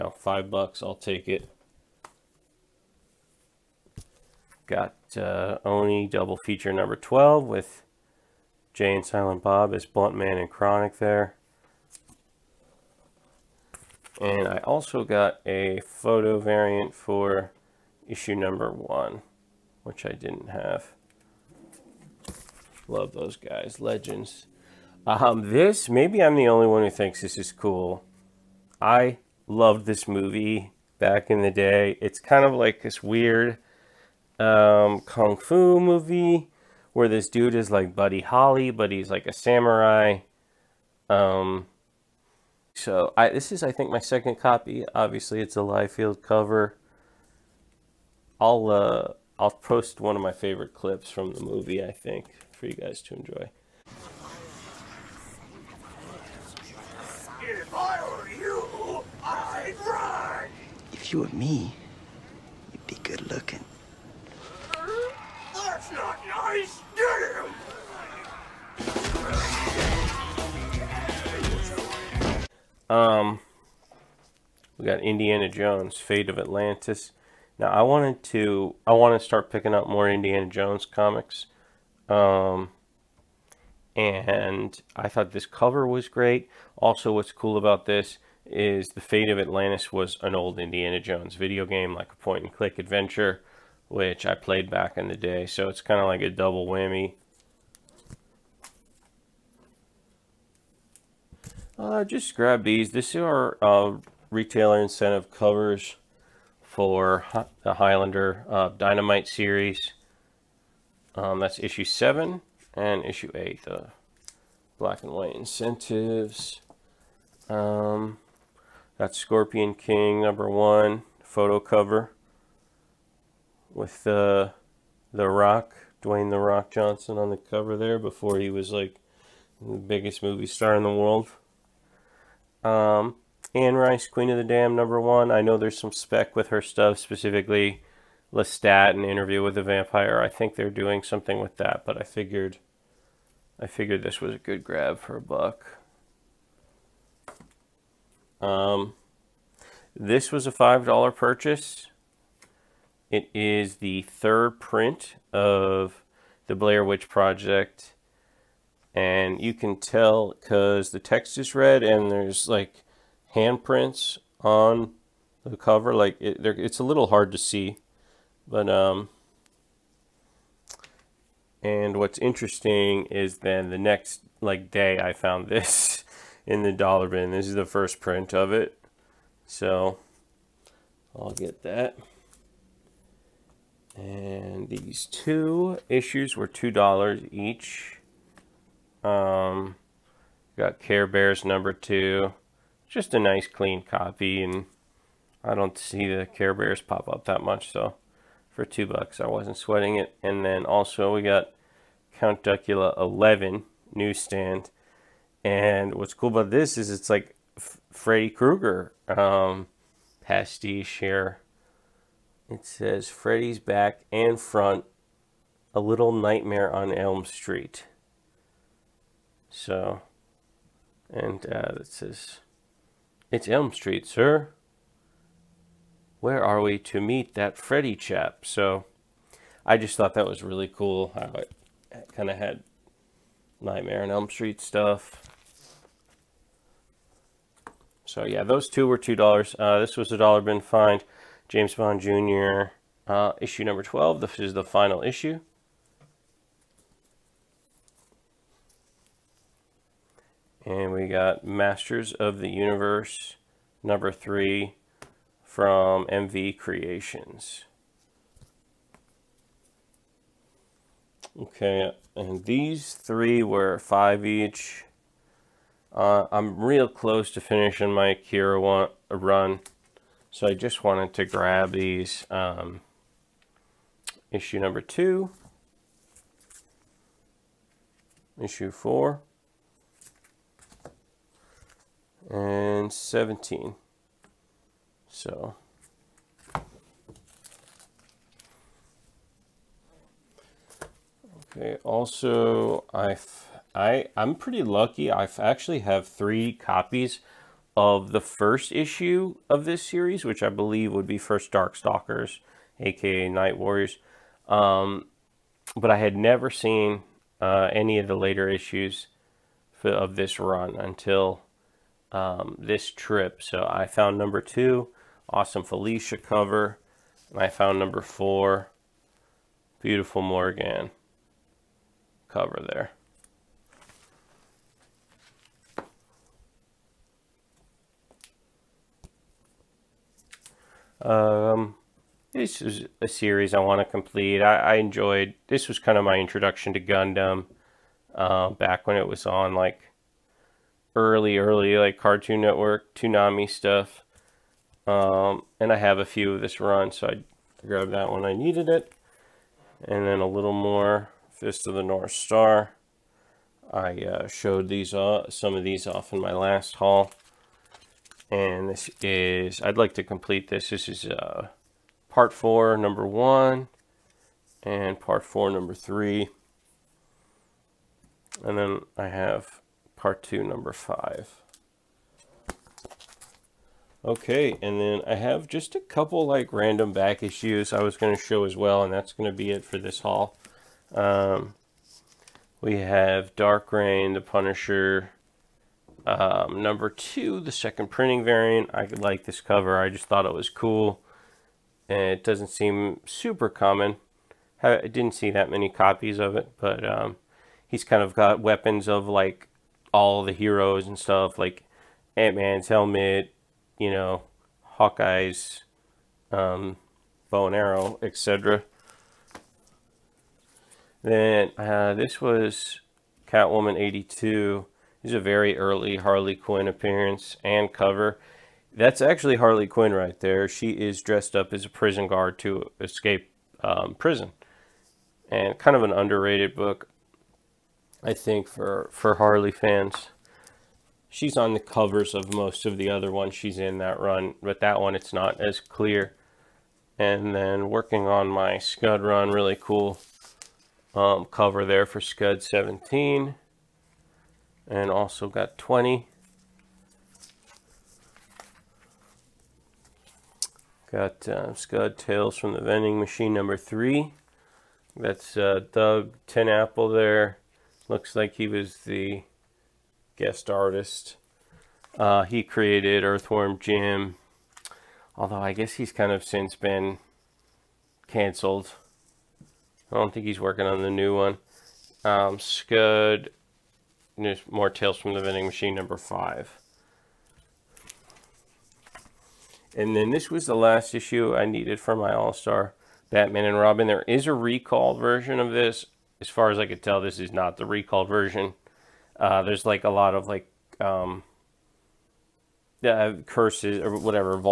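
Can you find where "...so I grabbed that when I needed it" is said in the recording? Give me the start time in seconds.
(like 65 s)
346 s.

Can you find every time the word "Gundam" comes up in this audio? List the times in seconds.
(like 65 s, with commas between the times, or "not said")
336 s.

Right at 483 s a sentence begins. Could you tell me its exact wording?
There is a recall version of this as far as I could tell, this is not the recalled version.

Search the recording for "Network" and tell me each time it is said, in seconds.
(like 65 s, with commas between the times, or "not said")
342 s.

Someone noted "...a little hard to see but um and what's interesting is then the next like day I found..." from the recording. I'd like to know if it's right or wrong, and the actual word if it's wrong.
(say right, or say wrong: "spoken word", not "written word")
right.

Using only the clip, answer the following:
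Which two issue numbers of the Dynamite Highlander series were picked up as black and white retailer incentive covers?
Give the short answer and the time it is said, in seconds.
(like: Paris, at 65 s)
7 and 8, at 111 s.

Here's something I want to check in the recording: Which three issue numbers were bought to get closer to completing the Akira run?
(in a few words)
2, 4, and 17.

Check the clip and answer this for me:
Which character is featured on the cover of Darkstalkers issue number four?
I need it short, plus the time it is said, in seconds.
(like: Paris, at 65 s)
Morgan, at 320 s.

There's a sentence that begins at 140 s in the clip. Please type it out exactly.
I think they're doing something with that, but I figured, I figured this was a good grab for a buck.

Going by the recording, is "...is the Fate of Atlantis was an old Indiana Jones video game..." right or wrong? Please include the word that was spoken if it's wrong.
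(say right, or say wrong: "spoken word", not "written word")
right.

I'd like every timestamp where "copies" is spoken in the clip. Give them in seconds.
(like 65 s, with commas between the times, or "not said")
296 s, 395 s.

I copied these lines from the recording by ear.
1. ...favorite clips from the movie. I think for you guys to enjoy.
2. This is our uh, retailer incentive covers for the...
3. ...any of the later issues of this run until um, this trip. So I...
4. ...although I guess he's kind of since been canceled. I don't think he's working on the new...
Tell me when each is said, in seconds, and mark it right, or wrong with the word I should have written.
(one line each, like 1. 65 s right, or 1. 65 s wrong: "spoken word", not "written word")
1. 50 s right
2. 102 s right
3. 307 s right
4. 465 s right.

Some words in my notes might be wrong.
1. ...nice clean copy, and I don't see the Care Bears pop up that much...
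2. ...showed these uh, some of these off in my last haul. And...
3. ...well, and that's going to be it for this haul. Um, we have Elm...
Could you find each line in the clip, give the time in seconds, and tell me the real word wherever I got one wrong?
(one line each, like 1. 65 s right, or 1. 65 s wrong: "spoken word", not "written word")
1. 193 s right
2. 354 s right
3. 378 s wrong: "Dark", not "Elm".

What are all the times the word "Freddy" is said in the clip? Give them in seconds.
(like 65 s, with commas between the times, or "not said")
207 s, 213 s, 227 s.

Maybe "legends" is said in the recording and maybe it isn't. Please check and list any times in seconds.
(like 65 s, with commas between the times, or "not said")
23 s.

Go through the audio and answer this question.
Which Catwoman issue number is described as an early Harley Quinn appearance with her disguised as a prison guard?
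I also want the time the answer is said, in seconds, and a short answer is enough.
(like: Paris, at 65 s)
82, at 413 s.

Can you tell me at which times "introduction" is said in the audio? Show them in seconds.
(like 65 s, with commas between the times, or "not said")
336 s.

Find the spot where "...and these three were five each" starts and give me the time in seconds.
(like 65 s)
262 s.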